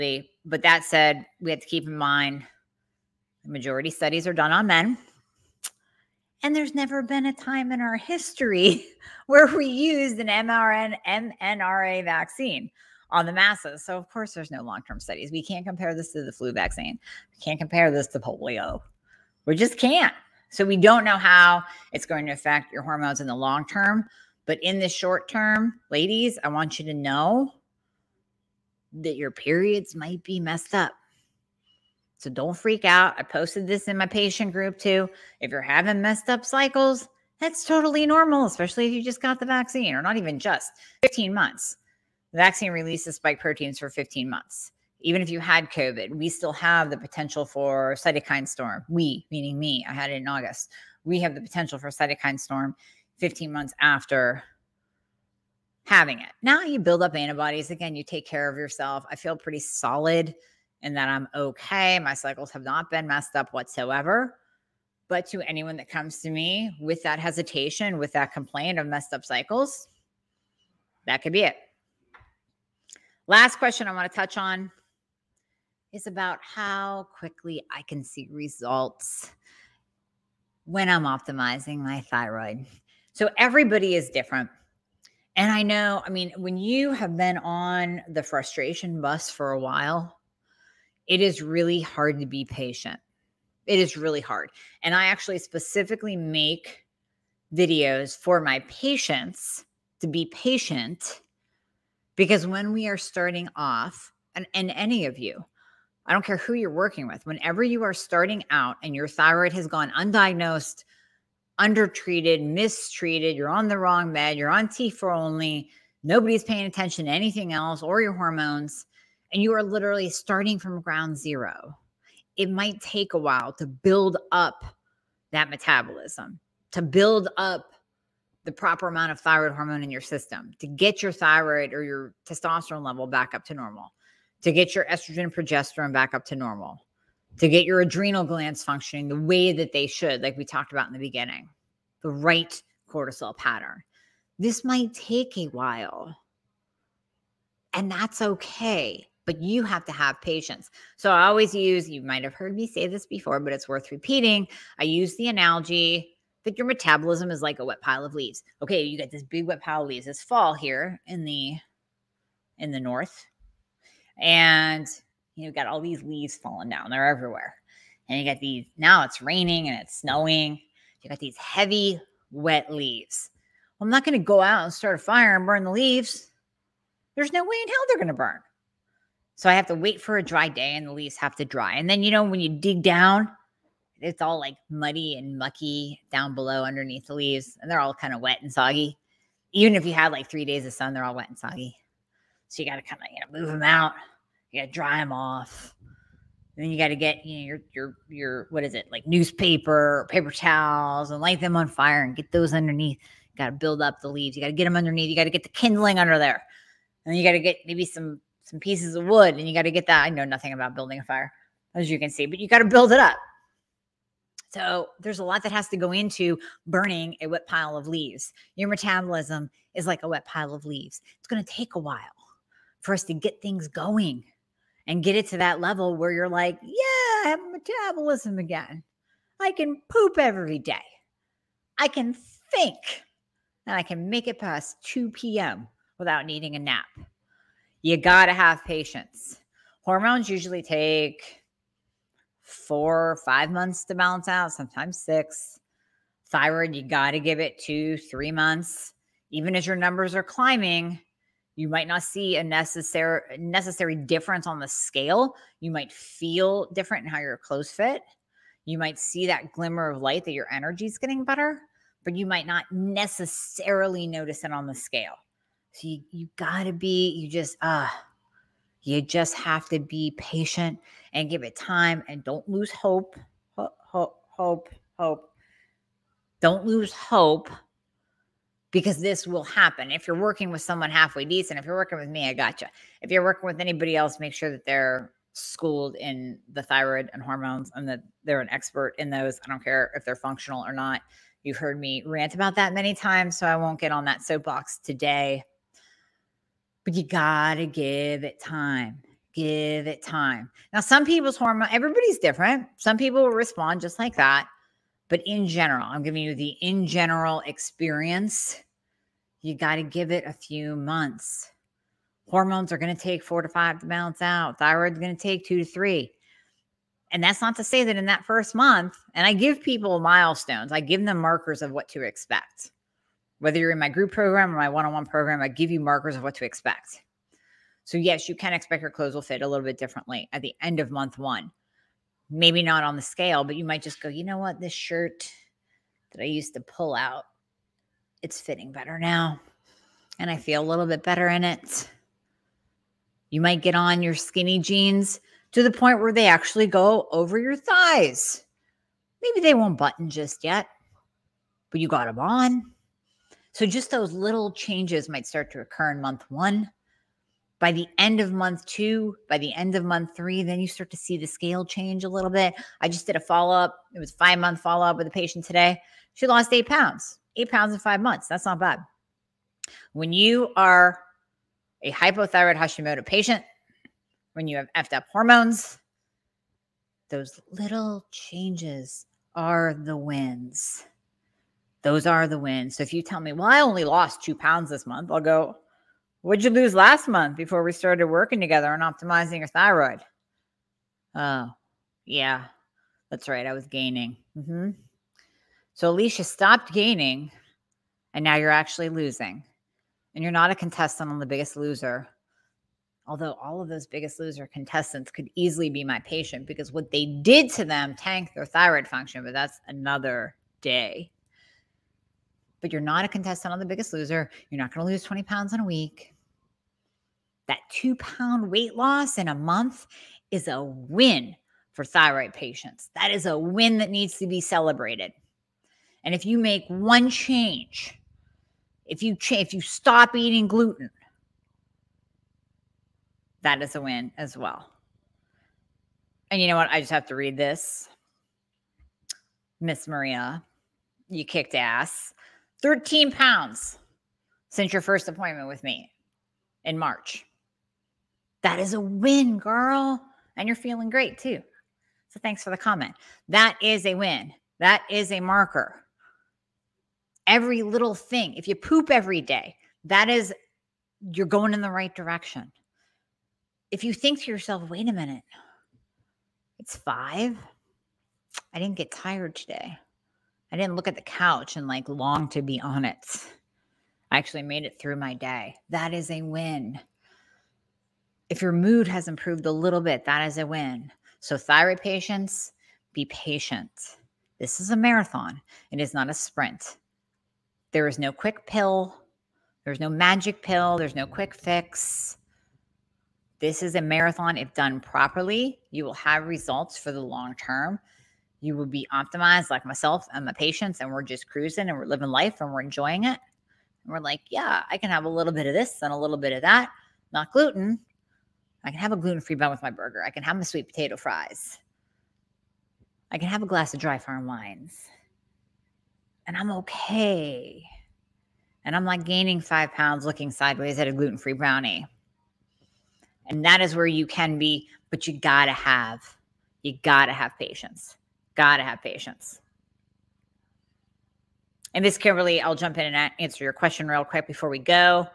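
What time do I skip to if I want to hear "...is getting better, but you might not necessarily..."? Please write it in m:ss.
4:20.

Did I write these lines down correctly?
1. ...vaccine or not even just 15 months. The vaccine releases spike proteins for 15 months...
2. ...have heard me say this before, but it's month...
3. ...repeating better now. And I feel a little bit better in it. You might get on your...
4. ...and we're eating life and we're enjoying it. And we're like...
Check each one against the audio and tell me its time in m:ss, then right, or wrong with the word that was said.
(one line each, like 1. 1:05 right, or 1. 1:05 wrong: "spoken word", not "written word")
1. 0:39 right
2. 2:32 wrong: "worth", not "month"
3. 5:38 wrong: "fitting", not "repeating"
4. 8:21 wrong: "living", not "eating".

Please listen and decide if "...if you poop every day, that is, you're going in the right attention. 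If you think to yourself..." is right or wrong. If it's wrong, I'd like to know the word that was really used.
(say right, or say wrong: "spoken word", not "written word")
wrong: "direction", not "attention".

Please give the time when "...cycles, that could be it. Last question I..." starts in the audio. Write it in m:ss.
1:09.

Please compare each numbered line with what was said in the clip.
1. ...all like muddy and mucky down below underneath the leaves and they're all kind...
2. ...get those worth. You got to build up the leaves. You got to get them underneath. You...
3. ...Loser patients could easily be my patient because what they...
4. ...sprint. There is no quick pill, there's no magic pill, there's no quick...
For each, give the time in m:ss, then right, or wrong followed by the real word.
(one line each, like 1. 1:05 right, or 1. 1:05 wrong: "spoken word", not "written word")
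1. 3:04 right
2. 3:22 wrong: "underneath", not "worth"
3. 6:44 wrong: "contestants", not "patients"
4. 8:06 right.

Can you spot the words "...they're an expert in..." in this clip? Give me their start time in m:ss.
4:48.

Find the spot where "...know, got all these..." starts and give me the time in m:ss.
2:45.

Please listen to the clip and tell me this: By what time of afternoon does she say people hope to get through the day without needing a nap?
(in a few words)
2 p.m.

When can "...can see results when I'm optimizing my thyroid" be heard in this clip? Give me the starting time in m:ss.
1:17.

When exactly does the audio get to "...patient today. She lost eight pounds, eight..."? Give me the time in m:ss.
6:05.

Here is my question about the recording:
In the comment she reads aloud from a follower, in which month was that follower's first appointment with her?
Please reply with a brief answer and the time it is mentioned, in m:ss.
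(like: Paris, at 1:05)
March, at 7:26.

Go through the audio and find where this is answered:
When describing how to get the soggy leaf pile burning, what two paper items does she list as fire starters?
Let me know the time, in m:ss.
3:19.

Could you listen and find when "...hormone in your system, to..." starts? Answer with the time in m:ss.
2:09.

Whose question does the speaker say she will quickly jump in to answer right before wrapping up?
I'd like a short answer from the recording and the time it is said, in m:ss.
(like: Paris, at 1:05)
Kimberly, at 8:51.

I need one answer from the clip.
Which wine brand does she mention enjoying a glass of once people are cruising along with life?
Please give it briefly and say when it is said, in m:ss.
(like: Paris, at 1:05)
Dry Farm Wines, at 8:33.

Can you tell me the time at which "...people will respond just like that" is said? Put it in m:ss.
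5:02.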